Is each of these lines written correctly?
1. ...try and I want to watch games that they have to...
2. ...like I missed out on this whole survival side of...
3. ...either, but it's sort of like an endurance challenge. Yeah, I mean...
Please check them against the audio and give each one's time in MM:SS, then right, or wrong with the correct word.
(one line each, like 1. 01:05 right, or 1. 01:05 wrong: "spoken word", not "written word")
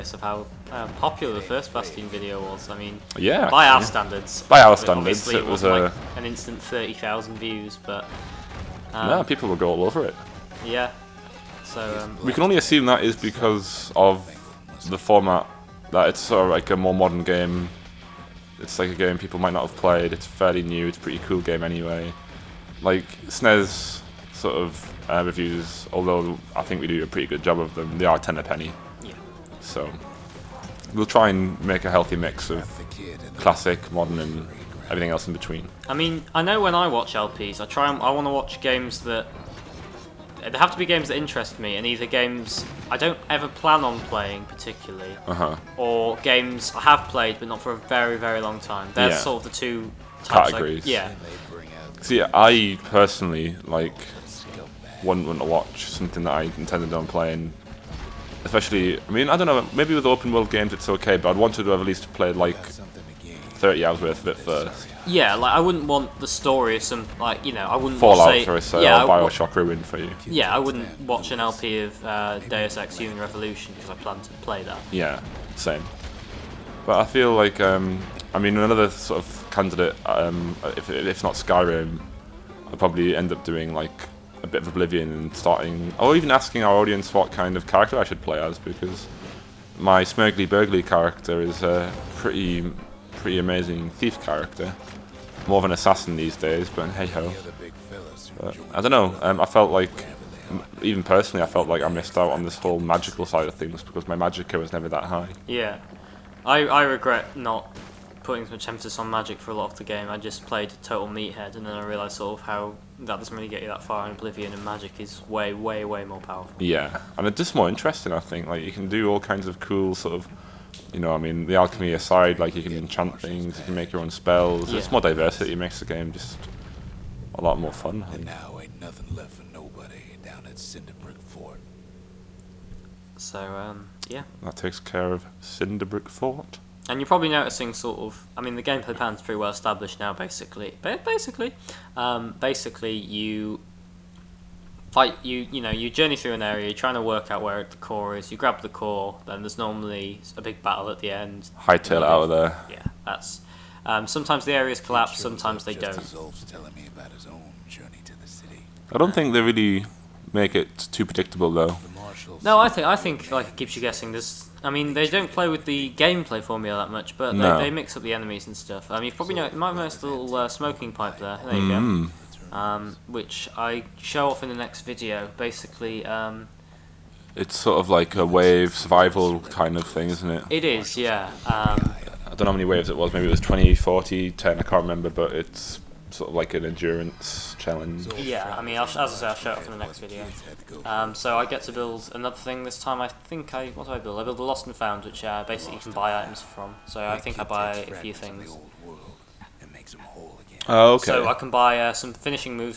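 1. 00:37 right
2. 01:41 wrong: "magical", not "survival"
3. 03:04 wrong: "remember", not "either".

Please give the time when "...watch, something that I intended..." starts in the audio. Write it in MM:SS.
00:55.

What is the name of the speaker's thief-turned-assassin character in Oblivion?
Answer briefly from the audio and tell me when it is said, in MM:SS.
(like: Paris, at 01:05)
Smurgly Burgly, at 01:30.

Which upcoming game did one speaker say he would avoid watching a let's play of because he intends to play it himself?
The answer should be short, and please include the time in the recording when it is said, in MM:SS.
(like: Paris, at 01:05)
Deus Ex Human Revolution, at 01:12.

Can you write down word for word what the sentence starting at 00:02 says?
I mean, yeah, by our standards.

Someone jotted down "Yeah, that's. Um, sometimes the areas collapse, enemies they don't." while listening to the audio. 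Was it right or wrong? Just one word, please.
wrong.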